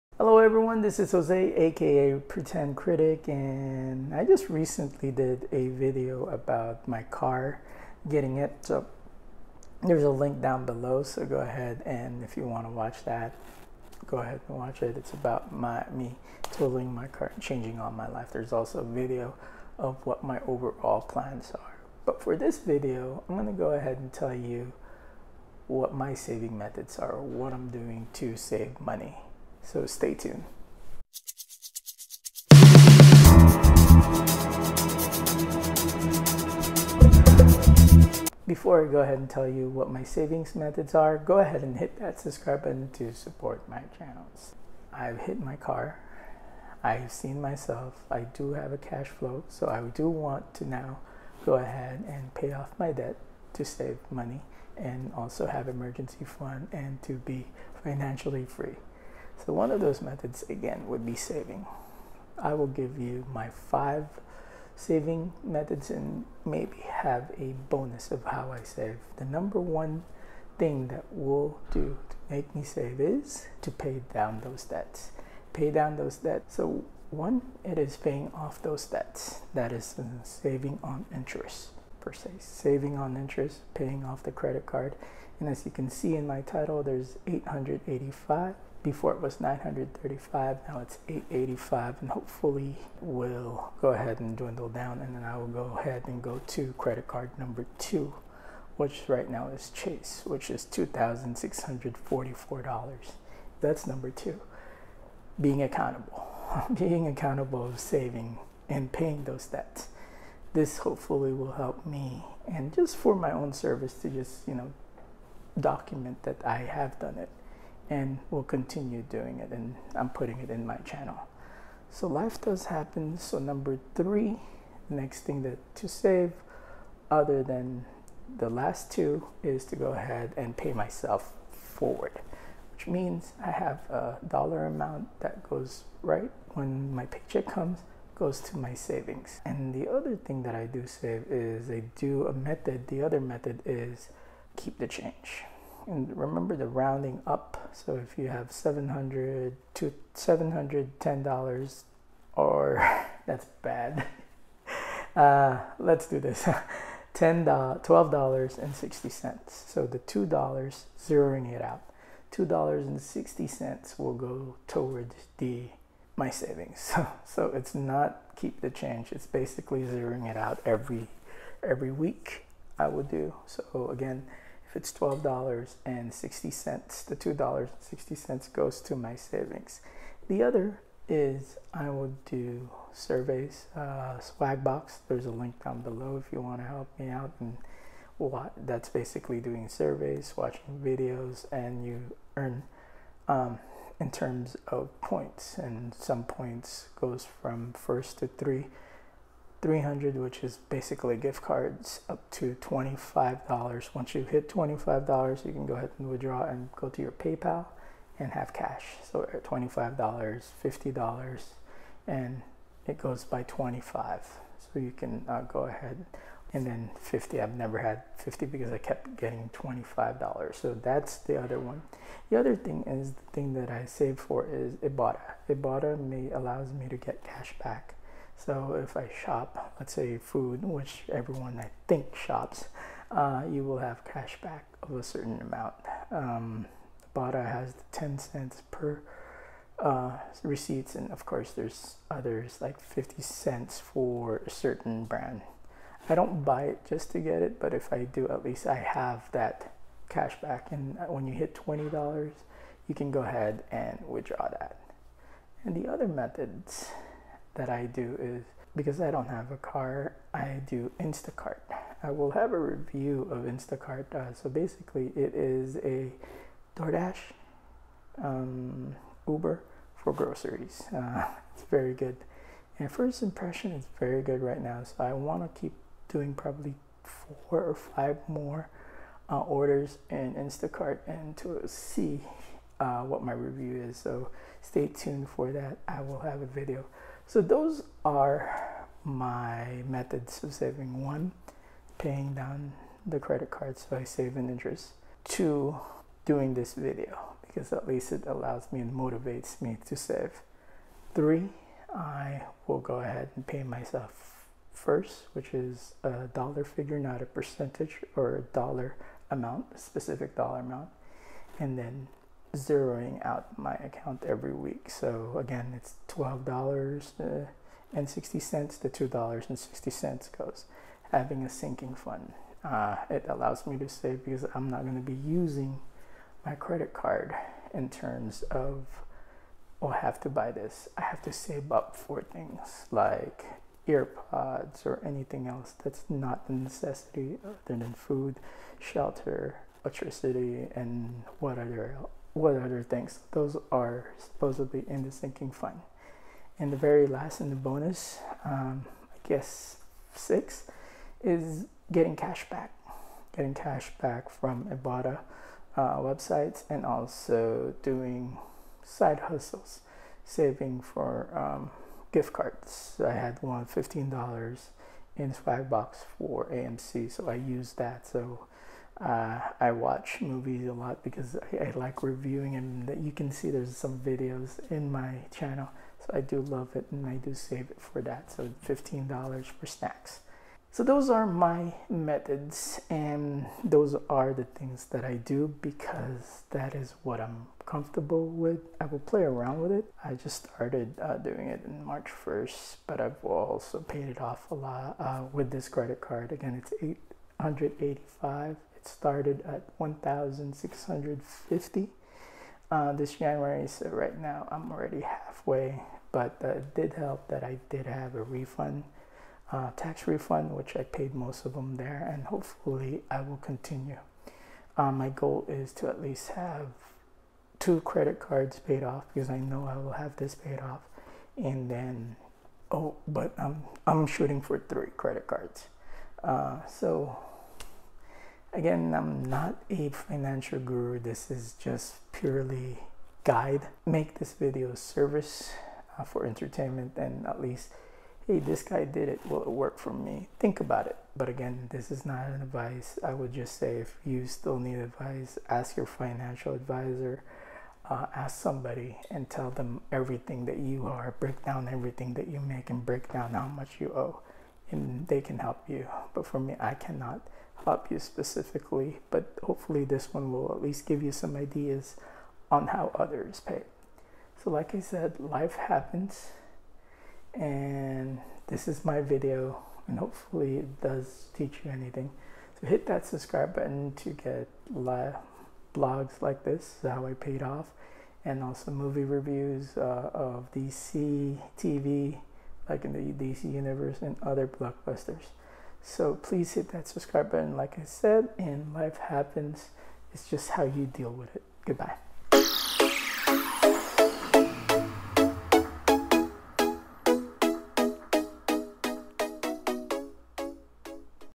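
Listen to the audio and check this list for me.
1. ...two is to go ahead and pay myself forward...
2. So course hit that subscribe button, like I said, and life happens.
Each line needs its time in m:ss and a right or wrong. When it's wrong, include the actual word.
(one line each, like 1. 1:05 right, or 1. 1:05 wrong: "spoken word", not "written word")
1. 2:08 right
2. 8:05 wrong: "please", not "course".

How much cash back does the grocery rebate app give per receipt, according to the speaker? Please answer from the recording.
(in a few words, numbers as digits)
10 cents.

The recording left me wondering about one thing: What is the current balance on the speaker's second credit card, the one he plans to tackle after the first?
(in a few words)
$2,644.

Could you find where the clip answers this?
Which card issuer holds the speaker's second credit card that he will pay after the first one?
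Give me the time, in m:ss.
1:39.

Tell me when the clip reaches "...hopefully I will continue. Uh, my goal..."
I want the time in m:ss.
6:52.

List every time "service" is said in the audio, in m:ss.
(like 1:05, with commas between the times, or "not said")
1:53, 7:14.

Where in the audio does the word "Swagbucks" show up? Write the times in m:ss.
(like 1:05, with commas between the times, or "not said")
3:04, 6:05.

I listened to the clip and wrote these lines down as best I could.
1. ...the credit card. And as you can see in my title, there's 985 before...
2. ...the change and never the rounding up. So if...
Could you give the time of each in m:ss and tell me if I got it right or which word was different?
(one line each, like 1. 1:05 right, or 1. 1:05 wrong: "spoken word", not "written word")
1. 1:24 wrong: "885", not "985"
2. 2:24 wrong: "remember", not "never".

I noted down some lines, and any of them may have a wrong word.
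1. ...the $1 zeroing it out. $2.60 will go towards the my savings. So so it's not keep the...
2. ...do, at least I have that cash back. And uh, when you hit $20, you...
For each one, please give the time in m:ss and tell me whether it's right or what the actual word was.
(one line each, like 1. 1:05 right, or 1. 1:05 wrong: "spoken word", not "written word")
1. 2:39 wrong: "2", not "1"
2. 4:08 right.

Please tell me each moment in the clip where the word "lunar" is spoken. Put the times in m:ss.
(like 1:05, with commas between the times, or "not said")
not said.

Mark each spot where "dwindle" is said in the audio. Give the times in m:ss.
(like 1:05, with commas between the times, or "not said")
1:34.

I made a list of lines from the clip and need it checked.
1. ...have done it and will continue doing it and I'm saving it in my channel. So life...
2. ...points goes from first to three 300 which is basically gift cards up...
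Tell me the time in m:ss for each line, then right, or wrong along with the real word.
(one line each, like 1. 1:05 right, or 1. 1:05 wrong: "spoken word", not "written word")
1. 1:56 wrong: "putting", not "saving"
2. 3:16 right.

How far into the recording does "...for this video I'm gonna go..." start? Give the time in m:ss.
0:22.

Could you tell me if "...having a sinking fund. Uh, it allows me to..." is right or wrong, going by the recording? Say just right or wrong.
right.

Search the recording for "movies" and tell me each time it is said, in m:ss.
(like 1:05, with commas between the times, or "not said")
6:10, 7:58.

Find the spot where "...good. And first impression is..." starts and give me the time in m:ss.
4:31.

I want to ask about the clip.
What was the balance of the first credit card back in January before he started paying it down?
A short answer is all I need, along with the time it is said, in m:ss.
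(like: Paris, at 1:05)
1,650, at 6:39.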